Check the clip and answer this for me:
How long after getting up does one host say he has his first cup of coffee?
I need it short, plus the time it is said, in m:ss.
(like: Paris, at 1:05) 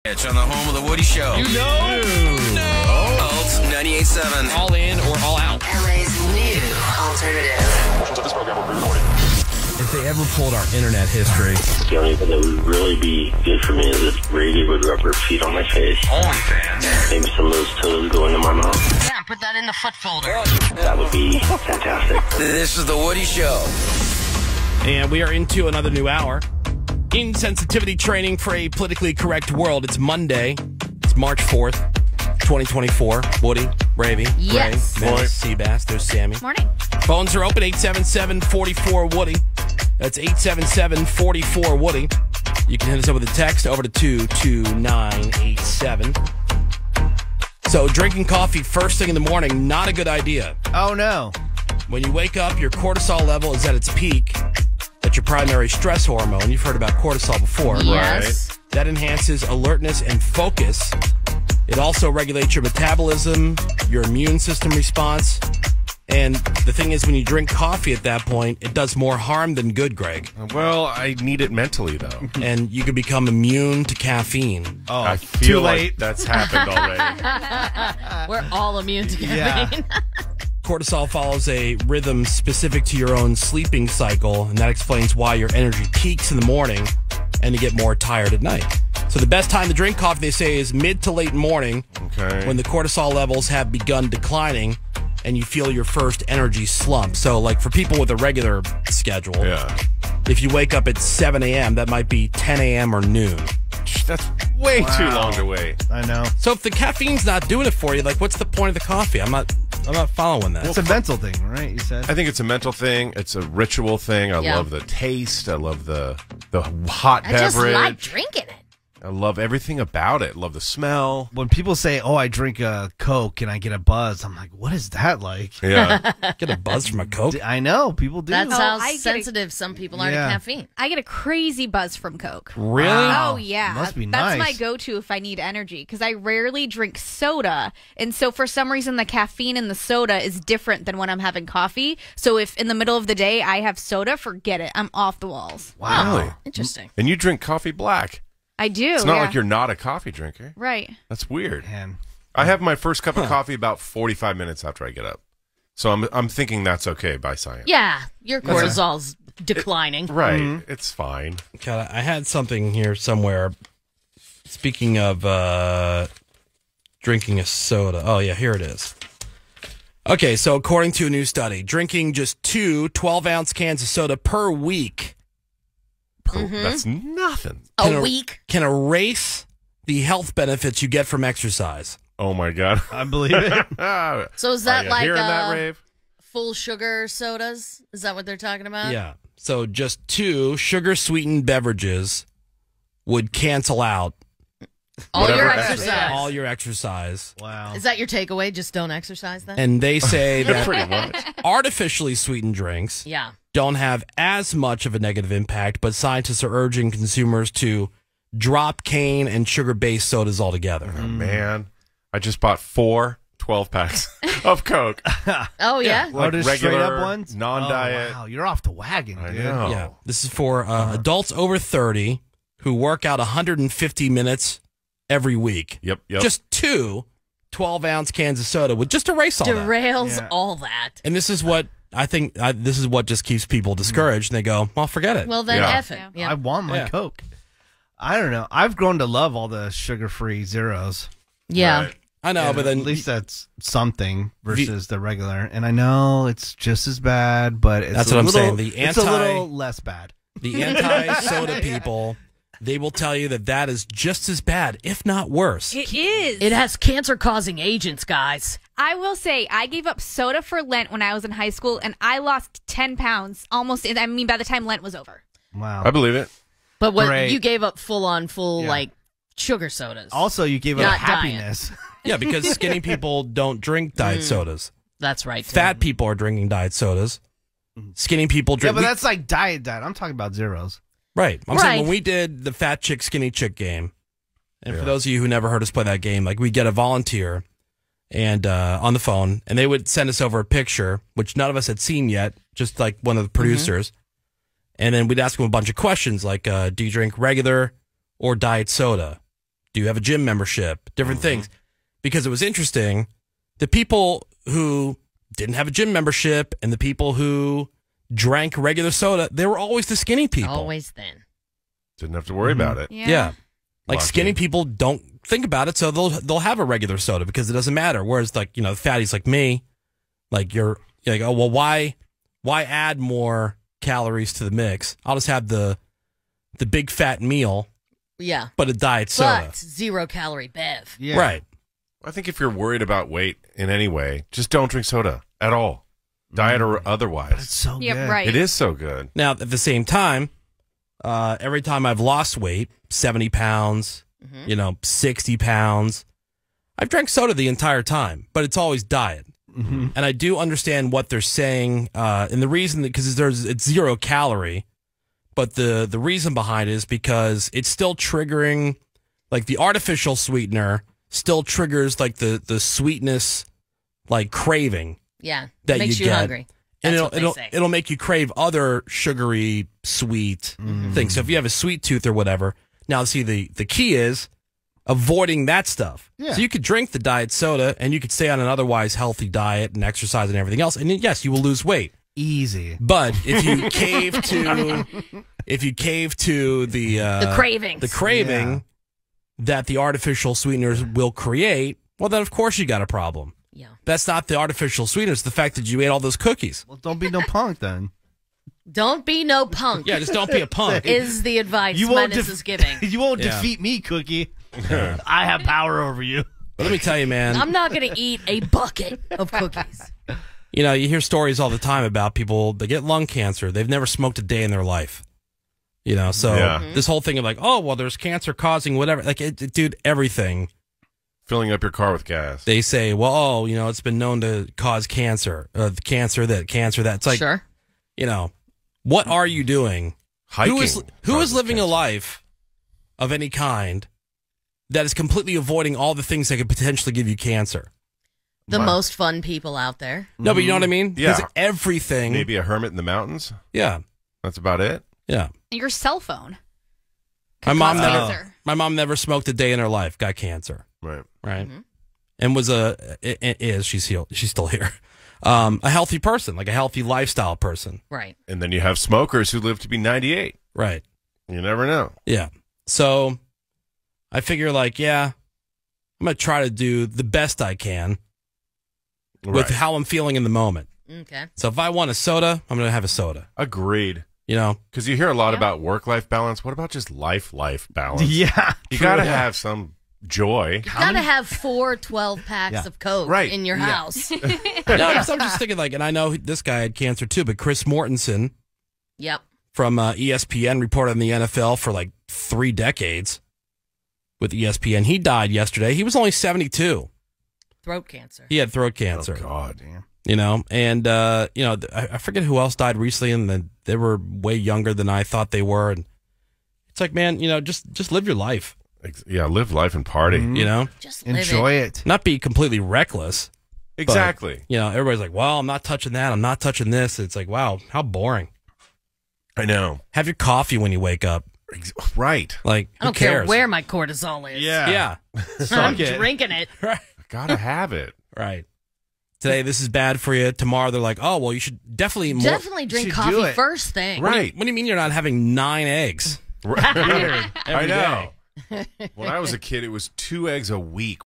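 45 minutes, at 2:33.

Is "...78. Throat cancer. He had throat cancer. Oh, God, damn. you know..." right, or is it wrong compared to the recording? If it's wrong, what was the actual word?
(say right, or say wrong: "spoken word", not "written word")
wrong: "72", not "78".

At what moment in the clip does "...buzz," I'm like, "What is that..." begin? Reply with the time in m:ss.
2:03.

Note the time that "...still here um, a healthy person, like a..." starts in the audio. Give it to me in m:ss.
7:34.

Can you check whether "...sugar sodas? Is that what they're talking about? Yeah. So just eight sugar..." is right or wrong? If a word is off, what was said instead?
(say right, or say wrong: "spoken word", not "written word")
wrong: "two", not "eight".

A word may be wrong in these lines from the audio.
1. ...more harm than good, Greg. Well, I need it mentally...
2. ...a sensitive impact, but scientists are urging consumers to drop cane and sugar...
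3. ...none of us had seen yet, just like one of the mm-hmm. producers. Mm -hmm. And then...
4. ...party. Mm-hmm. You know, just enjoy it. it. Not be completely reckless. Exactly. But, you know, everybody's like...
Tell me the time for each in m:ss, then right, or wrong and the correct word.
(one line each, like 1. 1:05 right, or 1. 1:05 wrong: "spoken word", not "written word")
1. 1:08 right
2. 3:24 wrong: "negative", not "sensitive"
3. 4:51 right
4. 8:29 right.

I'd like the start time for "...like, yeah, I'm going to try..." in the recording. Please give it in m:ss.
7:44.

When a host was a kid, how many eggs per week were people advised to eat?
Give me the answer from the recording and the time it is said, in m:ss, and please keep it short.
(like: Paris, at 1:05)
2, at 8:59.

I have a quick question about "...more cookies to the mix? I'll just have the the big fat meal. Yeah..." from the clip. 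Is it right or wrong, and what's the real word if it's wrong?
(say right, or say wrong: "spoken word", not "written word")
wrong: "calories", not "cookies".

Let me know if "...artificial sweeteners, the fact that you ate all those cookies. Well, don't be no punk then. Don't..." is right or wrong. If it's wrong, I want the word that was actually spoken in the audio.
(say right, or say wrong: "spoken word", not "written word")
right.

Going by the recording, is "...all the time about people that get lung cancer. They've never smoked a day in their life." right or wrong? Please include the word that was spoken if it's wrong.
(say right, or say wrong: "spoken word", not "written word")
right.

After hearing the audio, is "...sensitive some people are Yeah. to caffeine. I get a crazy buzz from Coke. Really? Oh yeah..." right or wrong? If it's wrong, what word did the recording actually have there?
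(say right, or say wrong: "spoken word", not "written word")
right.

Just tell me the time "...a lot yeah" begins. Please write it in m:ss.
7:55.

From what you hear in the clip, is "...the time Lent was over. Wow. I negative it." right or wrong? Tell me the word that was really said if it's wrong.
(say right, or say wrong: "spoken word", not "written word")
wrong: "believe", not "negative".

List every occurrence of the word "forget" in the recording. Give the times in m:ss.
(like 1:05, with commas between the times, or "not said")
2:24, 3:54, 8:21.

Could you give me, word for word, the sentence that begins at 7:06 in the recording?
It's like, Sure you know, what are you doing?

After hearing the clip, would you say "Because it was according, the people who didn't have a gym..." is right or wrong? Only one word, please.
wrong.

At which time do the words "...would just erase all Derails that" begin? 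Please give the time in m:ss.
3:48.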